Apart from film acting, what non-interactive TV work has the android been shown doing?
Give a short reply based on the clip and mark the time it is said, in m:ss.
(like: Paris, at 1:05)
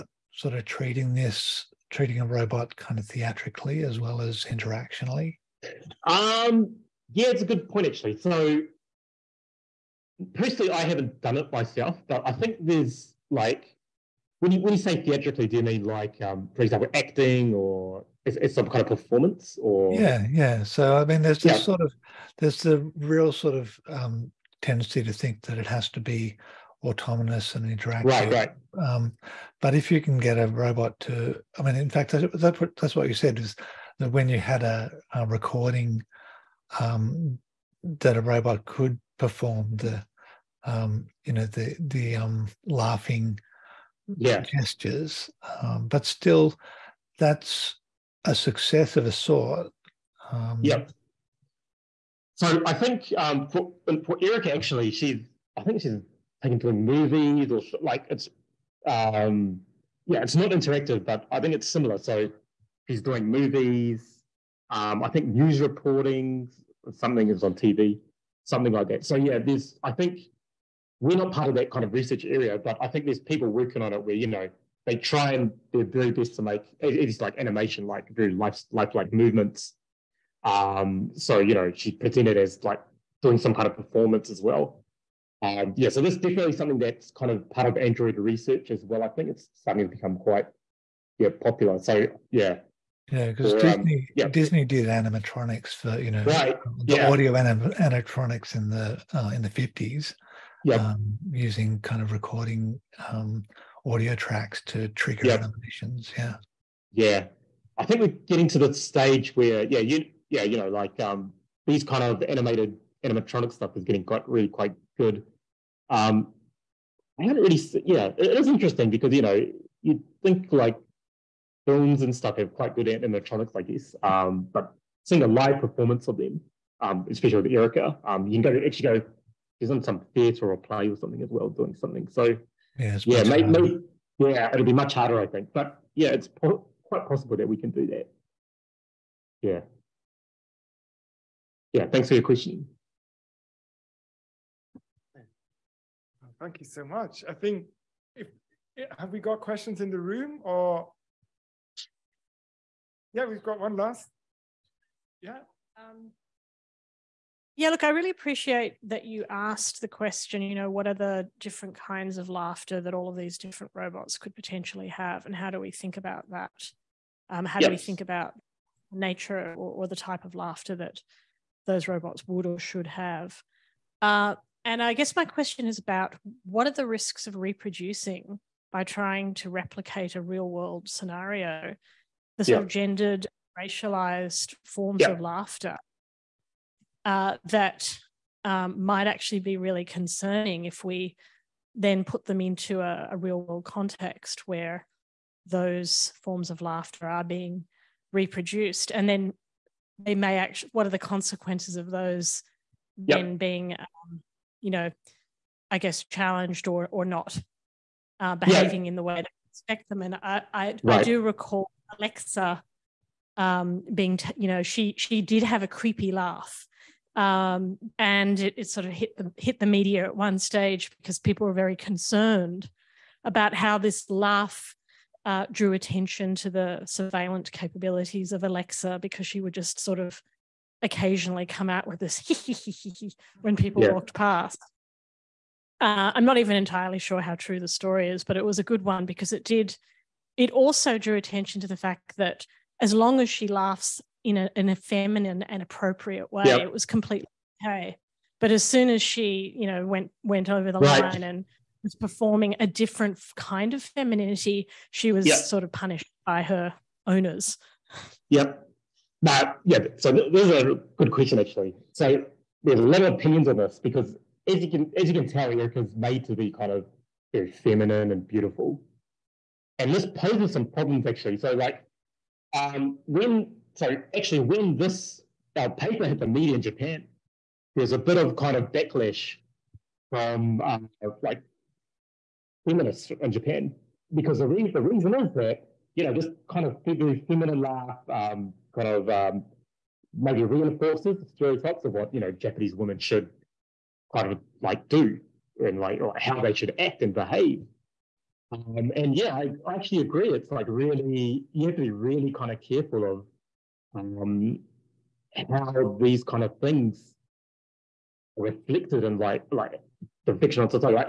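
news reporting, at 1:05.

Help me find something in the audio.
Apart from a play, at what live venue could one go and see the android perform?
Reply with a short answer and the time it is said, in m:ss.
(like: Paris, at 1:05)
theatre, at 2:10.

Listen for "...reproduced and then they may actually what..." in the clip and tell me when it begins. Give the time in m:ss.
3:18.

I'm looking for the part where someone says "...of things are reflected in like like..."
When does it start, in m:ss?
5:06.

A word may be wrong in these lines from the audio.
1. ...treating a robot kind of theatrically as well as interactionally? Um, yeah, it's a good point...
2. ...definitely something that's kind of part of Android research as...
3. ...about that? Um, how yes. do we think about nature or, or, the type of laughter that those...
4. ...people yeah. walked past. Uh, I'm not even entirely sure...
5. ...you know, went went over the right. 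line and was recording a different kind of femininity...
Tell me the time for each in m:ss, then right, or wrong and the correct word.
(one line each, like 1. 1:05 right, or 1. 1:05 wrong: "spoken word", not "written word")
1. 0:01 right
2. 1:26 right
3. 2:45 right
4. 3:53 right
5. 4:09 wrong: "performing", not "recording".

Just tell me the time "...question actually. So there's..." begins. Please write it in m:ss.
4:21.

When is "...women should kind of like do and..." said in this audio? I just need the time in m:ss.
4:52.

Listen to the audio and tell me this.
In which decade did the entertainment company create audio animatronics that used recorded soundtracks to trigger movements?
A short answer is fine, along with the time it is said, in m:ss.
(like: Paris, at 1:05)
1950s, at 1:39.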